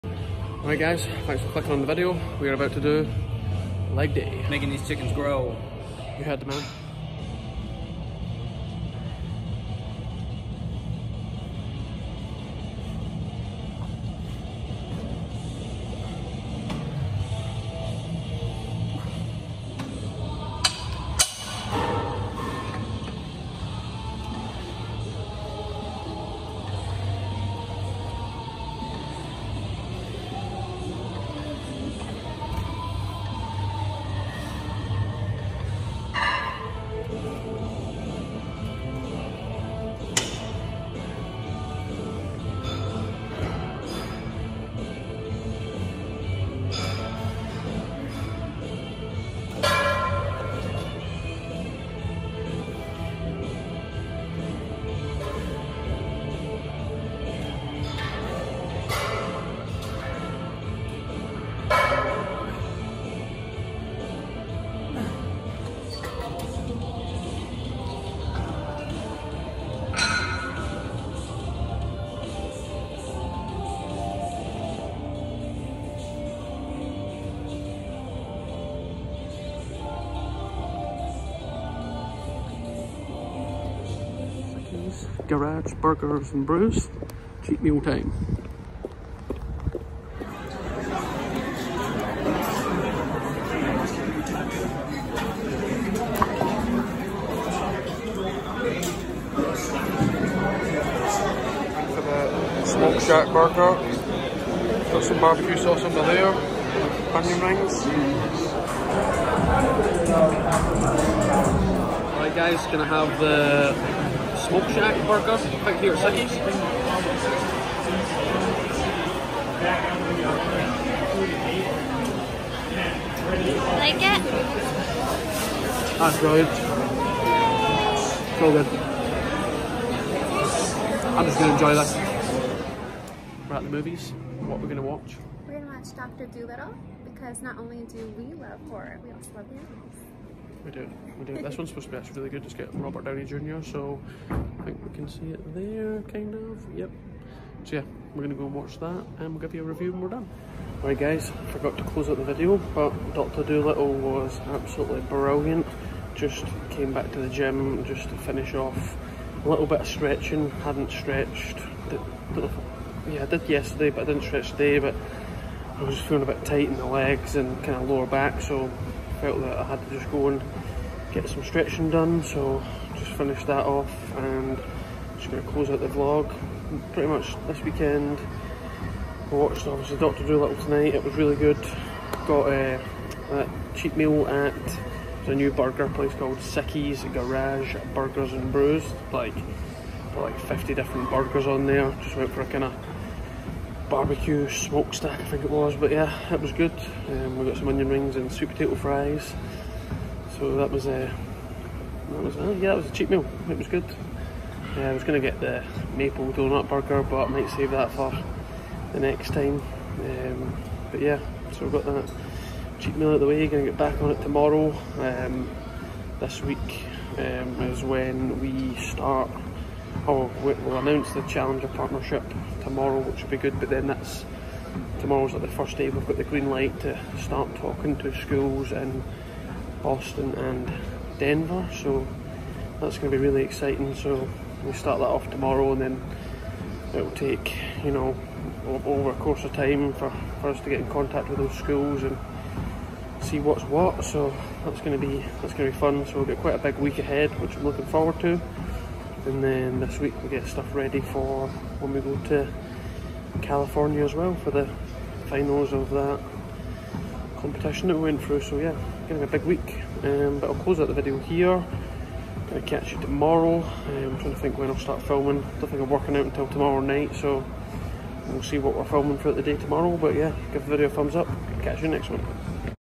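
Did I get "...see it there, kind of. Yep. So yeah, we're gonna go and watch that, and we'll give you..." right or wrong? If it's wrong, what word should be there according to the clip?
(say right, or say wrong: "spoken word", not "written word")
right.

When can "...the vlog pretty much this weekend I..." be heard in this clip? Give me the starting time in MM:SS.
02:55.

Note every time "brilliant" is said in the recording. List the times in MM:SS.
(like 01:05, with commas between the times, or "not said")
02:06, 02:35.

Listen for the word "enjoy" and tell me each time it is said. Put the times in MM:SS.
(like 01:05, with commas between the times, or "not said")
02:11.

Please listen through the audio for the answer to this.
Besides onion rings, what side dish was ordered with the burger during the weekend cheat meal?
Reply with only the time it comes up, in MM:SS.
03:18.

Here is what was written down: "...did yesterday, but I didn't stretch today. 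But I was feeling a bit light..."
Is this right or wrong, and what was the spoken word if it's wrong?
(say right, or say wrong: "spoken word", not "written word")
wrong: "tight", not "light".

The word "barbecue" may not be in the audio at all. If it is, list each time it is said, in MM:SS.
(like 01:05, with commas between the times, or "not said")
01:45, 03:13.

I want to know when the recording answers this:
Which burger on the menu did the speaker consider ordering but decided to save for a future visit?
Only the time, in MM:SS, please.
03:25.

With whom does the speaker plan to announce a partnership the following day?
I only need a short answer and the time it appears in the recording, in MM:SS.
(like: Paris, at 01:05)
Challenger, at 03:41.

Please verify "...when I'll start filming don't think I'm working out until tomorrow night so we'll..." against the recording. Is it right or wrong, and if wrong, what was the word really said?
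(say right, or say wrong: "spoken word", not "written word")
right.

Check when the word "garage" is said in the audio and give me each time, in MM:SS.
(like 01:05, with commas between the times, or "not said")
01:25, 03:07.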